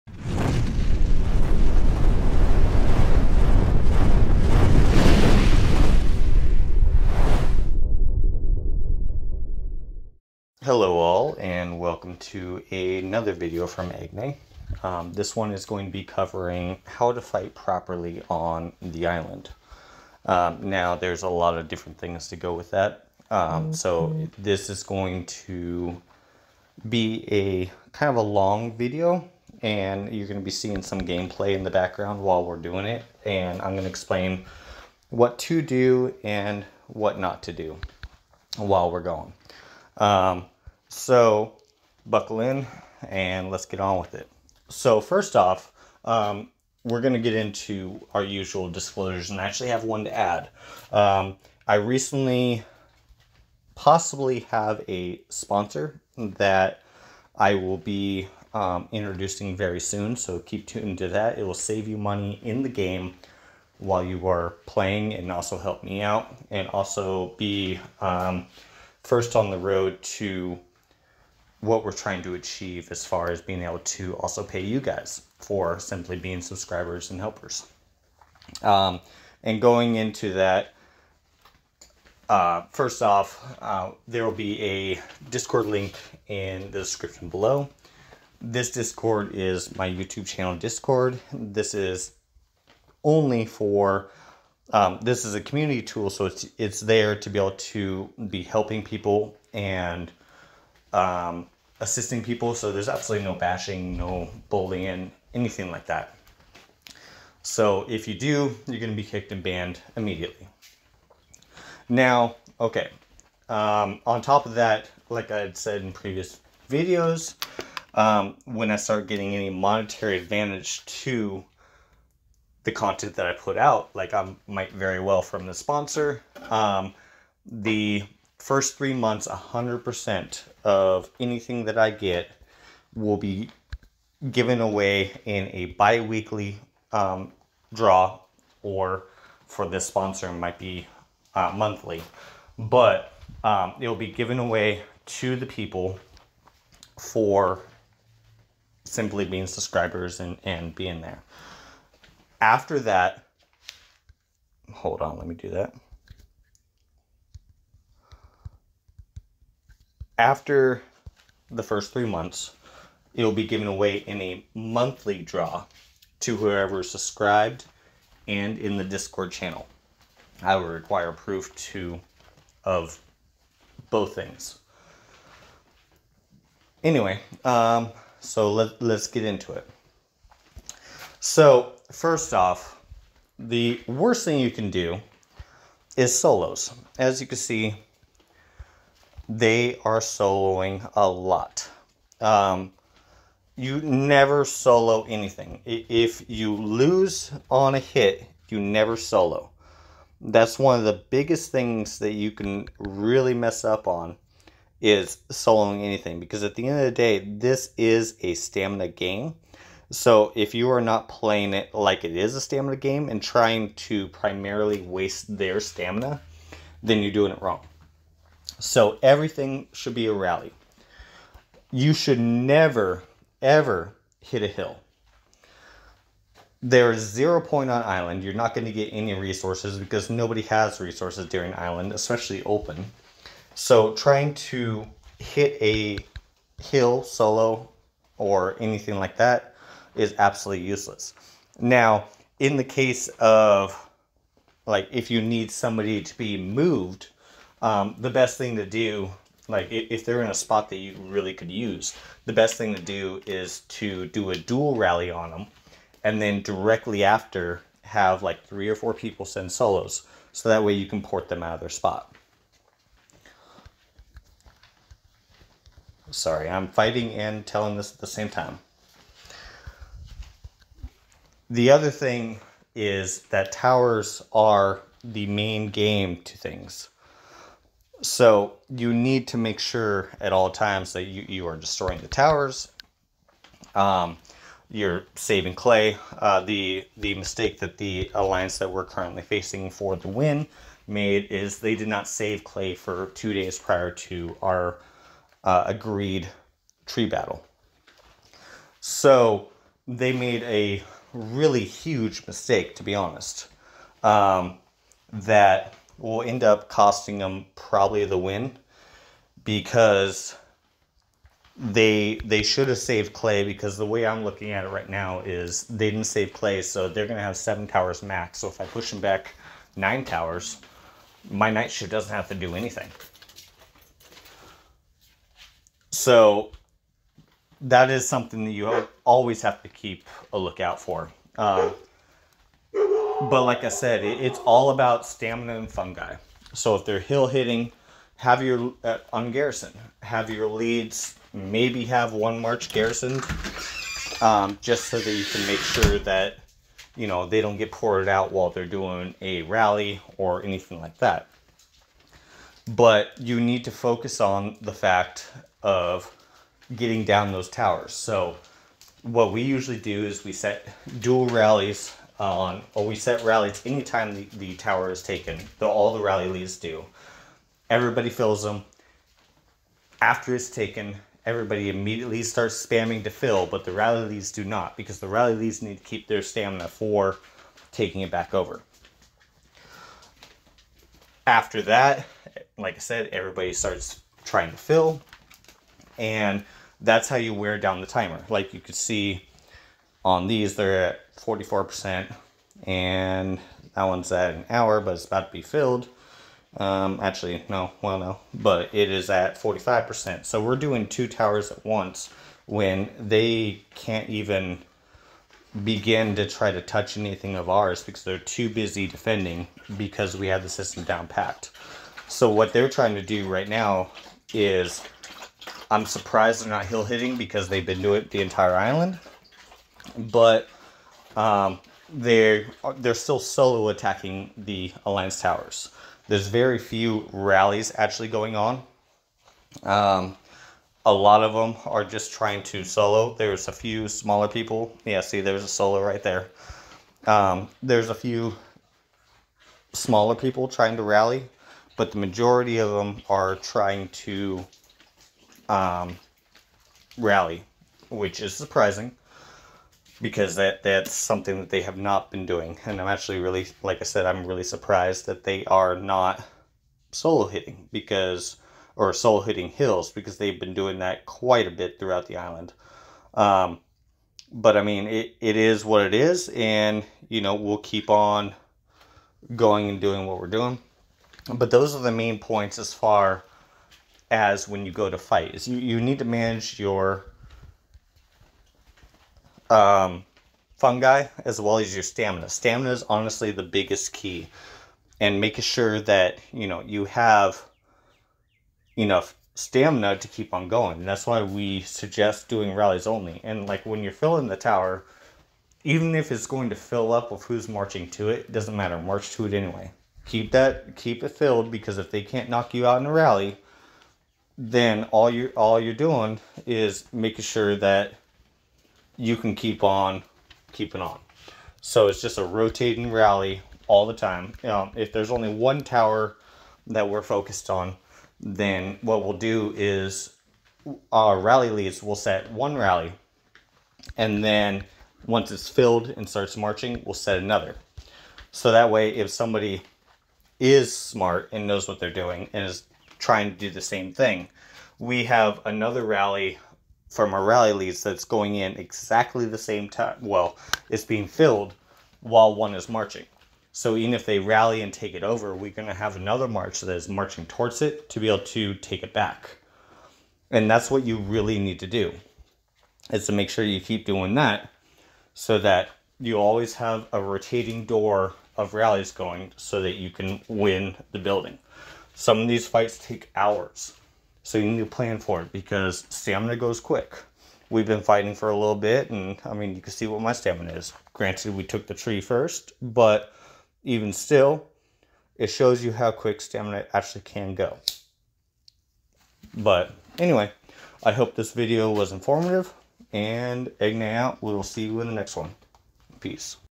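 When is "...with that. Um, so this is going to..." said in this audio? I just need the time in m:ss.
0:22.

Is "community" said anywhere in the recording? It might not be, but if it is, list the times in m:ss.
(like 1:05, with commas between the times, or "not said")
1:35.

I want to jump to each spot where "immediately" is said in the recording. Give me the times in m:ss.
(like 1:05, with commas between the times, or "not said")
1:49, 6:11.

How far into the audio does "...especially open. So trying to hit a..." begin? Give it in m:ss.
3:51.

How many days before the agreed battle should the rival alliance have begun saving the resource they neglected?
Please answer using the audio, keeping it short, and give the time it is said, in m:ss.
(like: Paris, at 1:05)
2, at 4:53.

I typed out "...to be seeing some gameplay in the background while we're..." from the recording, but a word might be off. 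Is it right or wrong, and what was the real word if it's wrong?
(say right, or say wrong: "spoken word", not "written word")
right.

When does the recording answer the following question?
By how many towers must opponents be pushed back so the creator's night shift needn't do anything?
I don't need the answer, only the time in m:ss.
5:19.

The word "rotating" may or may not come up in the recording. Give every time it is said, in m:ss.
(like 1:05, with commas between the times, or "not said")
8:32, 9:17.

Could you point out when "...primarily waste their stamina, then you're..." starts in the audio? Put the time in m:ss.
3:34.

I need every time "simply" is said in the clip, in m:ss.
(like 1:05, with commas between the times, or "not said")
1:15, 2:28.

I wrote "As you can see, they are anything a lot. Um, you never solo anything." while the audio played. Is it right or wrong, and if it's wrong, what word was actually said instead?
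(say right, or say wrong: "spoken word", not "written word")
wrong: "soloing", not "anything".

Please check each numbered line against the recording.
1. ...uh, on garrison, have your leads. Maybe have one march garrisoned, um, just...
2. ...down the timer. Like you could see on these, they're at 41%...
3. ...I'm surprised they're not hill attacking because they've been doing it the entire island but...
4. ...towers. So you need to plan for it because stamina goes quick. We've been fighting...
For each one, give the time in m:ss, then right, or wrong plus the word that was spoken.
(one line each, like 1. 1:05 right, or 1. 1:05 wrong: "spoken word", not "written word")
1. 5:38 right
2. 6:27 wrong: "44", not "41"
3. 6:55 wrong: "hitting", not "attacking"
4. 9:23 wrong: "hours", not "towers".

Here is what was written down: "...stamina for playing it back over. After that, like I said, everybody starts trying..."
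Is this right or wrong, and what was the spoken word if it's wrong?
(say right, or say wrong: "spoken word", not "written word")
wrong: "taking", not "playing".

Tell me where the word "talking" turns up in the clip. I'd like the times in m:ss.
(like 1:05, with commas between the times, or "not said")
not said.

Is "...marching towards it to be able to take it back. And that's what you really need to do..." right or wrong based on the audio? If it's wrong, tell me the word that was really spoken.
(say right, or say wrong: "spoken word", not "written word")
right.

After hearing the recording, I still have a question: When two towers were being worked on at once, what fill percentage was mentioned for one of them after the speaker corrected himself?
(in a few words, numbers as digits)
45%.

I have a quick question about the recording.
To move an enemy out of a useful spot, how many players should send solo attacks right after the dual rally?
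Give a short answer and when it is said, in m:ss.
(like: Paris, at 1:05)
3 or 4, at 4:18.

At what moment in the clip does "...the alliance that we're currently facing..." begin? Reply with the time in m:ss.
4:47.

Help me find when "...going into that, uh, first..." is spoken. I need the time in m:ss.
1:19.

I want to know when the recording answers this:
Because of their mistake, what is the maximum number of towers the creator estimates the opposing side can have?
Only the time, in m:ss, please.
5:17.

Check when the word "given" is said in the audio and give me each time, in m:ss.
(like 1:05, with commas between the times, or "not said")
2:14, 2:24, 2:43.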